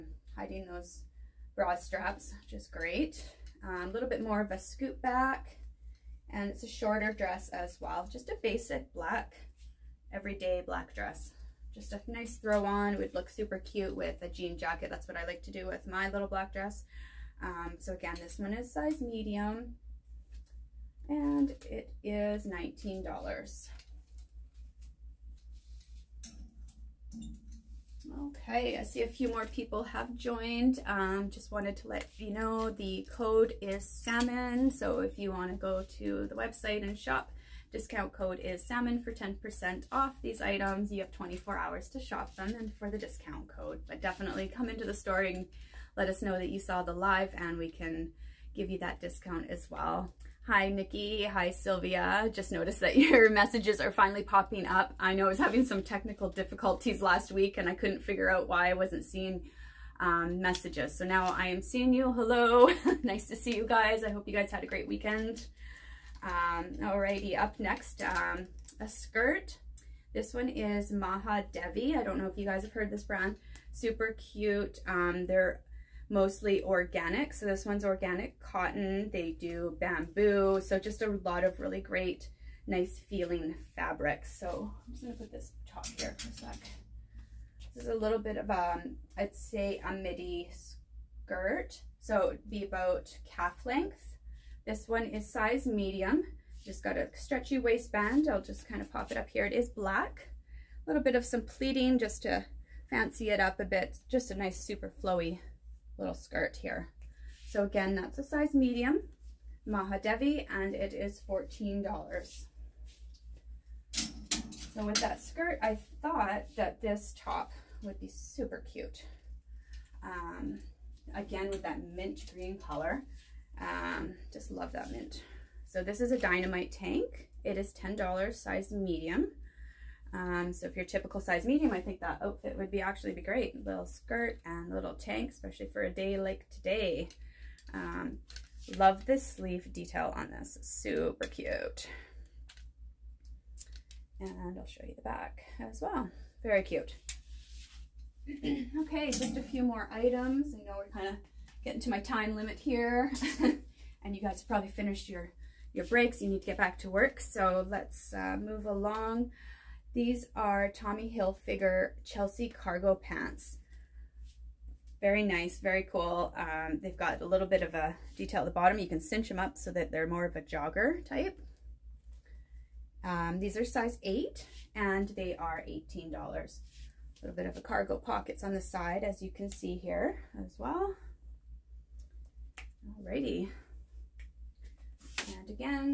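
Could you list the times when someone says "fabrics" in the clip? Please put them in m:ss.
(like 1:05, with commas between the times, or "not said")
1:23.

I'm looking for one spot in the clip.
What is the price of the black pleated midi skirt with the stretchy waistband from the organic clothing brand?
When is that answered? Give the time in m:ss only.
1:51.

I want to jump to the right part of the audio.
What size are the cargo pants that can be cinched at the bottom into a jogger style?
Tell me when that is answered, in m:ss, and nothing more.
2:53.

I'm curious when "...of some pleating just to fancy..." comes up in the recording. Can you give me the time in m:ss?
1:41.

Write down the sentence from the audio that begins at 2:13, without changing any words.
little skirt and little tank, especially for a day like today.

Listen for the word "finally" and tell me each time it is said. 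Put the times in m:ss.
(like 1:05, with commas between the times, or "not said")
0:53.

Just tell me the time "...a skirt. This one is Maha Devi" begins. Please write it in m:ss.
1:08.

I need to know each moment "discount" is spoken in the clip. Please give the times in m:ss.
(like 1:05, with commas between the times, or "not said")
0:37, 0:42, 0:48.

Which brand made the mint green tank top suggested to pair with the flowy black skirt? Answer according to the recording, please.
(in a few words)
Dynamite.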